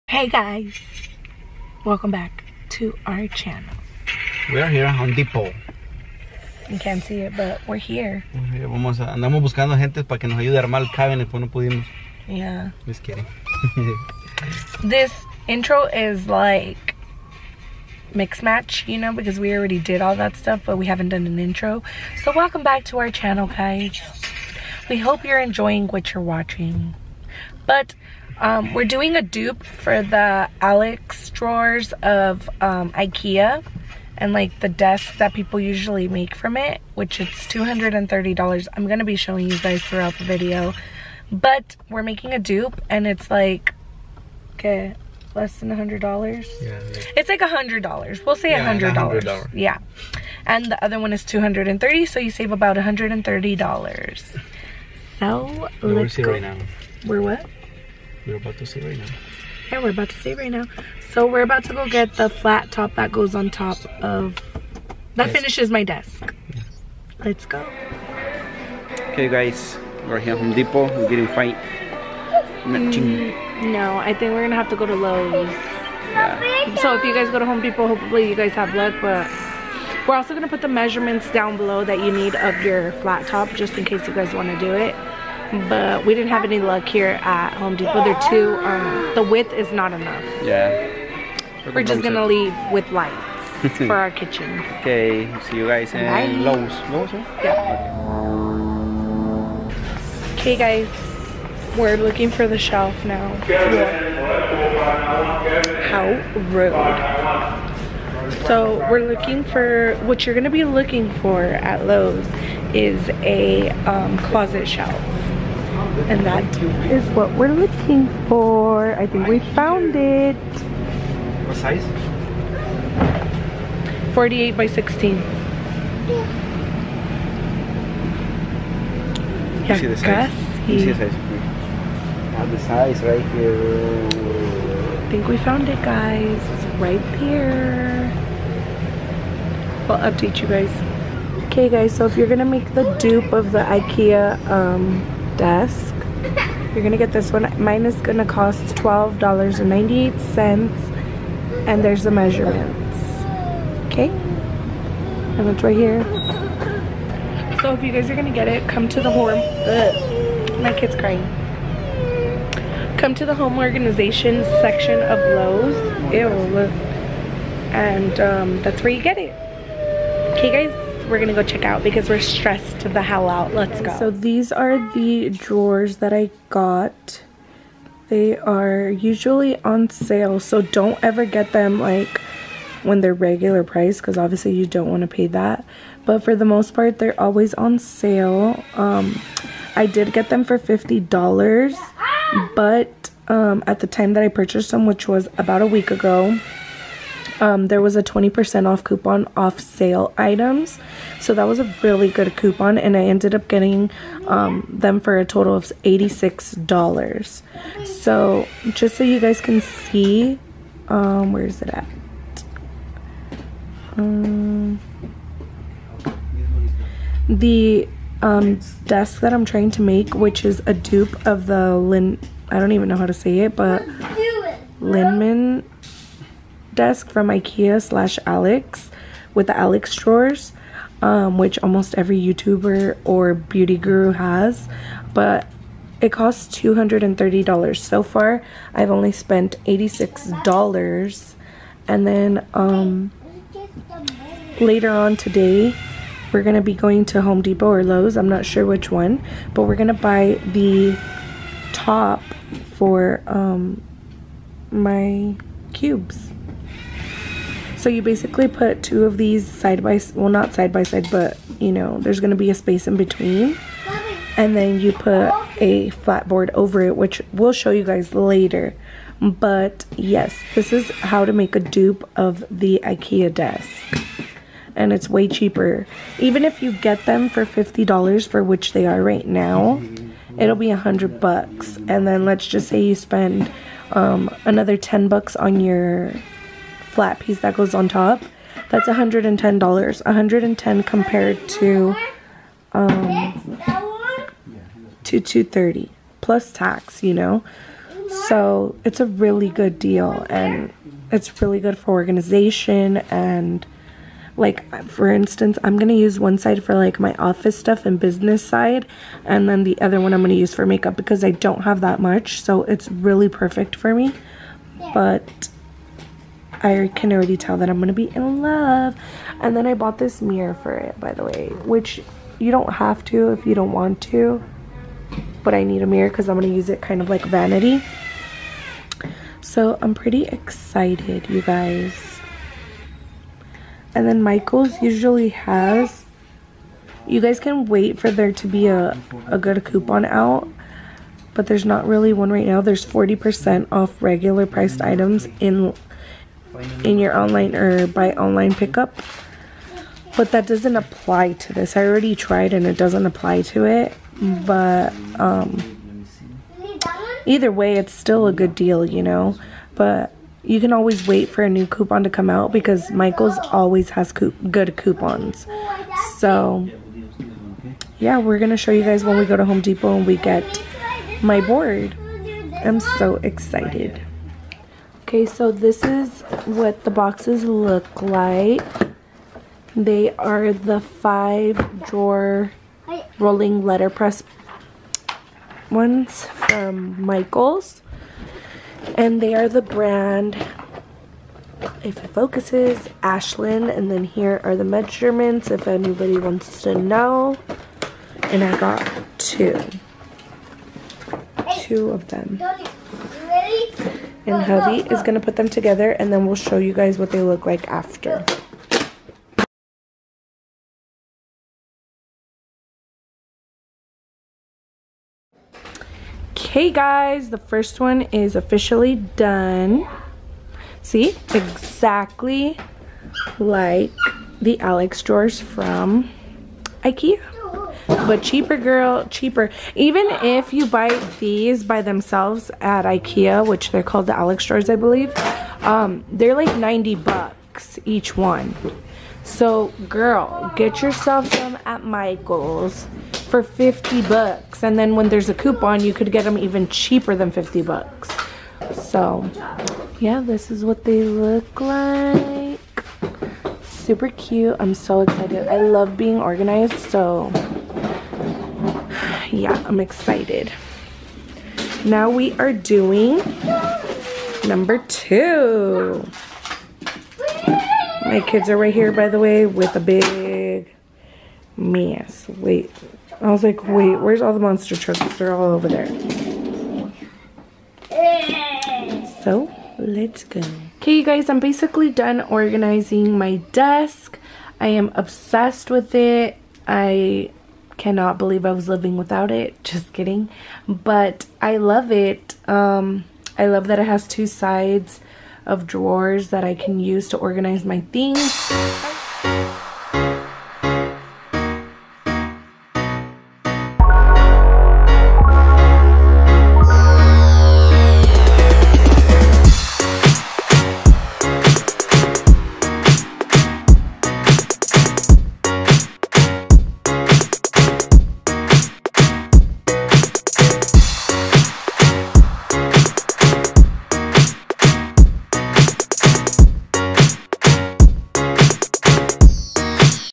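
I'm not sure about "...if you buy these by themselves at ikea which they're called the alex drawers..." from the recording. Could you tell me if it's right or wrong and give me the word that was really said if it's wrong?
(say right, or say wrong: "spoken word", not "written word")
right.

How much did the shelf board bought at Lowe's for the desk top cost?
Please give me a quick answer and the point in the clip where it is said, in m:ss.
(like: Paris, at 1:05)
$12.98, at 2:28.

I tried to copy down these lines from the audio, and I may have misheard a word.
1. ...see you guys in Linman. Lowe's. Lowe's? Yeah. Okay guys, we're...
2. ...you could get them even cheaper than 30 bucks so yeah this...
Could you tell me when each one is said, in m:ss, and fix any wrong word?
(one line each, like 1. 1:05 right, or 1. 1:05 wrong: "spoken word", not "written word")
1. 1:35 wrong: "Bye", not "Linman"
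2. 7:25 wrong: "50", not "30".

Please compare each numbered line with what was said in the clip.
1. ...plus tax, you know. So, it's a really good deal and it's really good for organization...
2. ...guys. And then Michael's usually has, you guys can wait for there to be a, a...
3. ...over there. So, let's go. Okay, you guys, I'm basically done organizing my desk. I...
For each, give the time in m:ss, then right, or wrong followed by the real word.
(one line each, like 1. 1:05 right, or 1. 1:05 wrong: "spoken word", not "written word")
1. 4:56 right
2. 5:31 right
3. 7:55 right.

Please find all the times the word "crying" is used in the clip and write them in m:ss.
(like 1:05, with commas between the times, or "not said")
2:40.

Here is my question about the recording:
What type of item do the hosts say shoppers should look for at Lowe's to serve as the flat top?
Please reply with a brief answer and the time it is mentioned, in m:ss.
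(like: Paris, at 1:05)
closet shelf, at 1:54.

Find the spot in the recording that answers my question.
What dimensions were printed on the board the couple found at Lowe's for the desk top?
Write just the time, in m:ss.
2:04.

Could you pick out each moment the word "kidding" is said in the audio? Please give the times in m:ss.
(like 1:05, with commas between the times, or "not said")
0:13, 8:09.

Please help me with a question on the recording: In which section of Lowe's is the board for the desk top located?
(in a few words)
home organization section.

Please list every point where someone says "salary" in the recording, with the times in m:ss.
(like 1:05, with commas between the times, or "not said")
not said.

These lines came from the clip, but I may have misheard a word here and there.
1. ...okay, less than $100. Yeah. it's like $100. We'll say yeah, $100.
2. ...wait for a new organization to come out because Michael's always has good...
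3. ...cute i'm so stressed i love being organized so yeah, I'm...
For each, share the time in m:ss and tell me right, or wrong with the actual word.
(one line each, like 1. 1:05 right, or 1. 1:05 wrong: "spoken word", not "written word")
1. 0:44 right
2. 6:01 wrong: "coupon", not "organization"
3. 7:34 wrong: "excited", not "stressed".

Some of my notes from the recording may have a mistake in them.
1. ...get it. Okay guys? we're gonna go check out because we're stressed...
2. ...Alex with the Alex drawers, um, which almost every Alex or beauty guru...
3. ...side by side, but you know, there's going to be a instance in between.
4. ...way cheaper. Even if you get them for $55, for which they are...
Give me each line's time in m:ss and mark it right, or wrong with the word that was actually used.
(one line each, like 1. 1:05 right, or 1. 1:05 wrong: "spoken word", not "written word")
1. 2:49 right
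2. 3:48 wrong: "YouTuber", not "Alex"
3. 4:20 wrong: "space", not "instance"
4. 4:35 wrong: "50", not "55".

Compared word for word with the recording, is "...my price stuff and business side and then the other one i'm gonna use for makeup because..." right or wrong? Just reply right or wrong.
wrong.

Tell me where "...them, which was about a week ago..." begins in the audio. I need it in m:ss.
3:14.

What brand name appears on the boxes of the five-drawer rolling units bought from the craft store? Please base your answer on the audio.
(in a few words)
Ashland.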